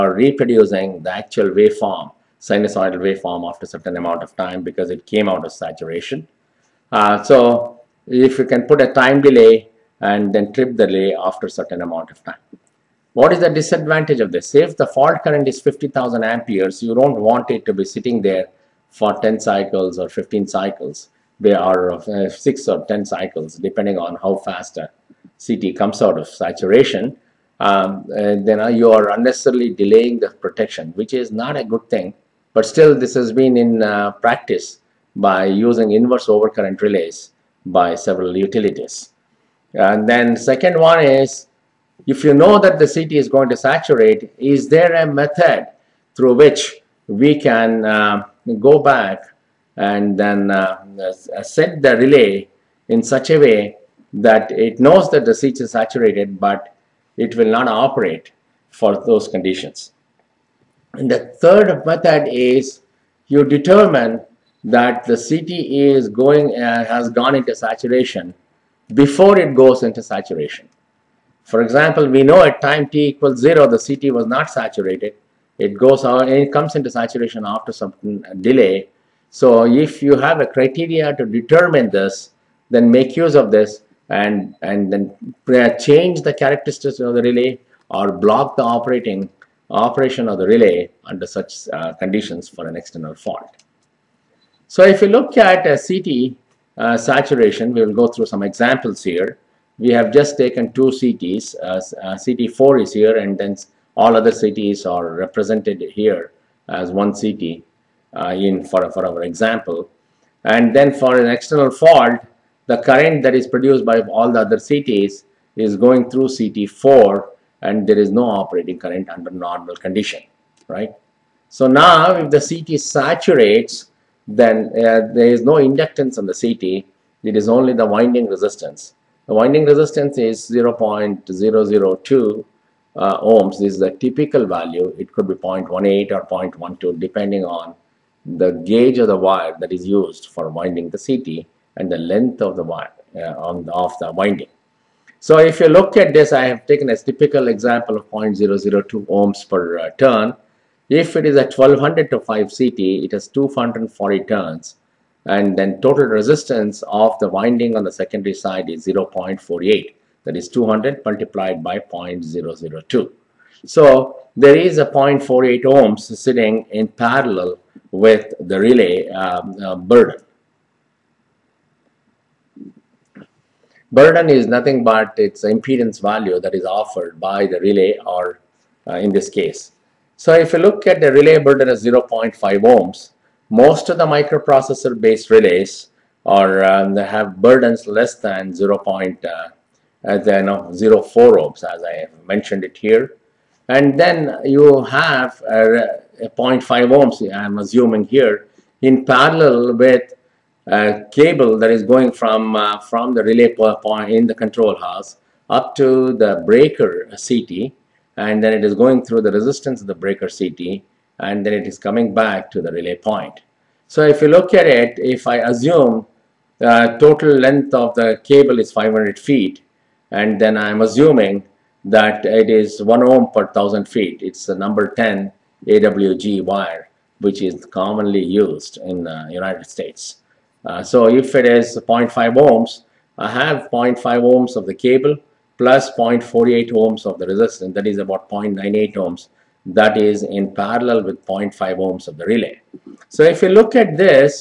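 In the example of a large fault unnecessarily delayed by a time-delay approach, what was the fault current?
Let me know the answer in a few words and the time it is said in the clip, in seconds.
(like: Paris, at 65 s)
50,000 amperes, at 15 s.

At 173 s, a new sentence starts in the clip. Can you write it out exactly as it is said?
Burden is nothing but its impedance value that is offered by the relay or uh, in this case.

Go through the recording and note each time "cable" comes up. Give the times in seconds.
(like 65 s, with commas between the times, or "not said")
201 s, 218 s, 234 s.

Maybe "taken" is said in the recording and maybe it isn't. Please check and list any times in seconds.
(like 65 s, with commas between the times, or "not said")
100 s, 146 s.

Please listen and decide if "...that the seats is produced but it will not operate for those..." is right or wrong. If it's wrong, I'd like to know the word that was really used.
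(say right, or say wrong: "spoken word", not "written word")
wrong: "saturated", not "produced".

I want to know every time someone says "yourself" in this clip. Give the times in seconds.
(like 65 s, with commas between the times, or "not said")
not said.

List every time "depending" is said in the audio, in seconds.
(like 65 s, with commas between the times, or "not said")
23 s, 136 s.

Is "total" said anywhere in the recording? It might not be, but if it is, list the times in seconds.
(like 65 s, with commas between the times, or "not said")
155 s, 216 s.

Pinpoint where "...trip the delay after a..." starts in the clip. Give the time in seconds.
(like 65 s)
10 s.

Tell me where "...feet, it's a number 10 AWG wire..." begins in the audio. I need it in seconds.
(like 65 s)
223 s.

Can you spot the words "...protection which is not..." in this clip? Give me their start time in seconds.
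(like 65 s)
30 s.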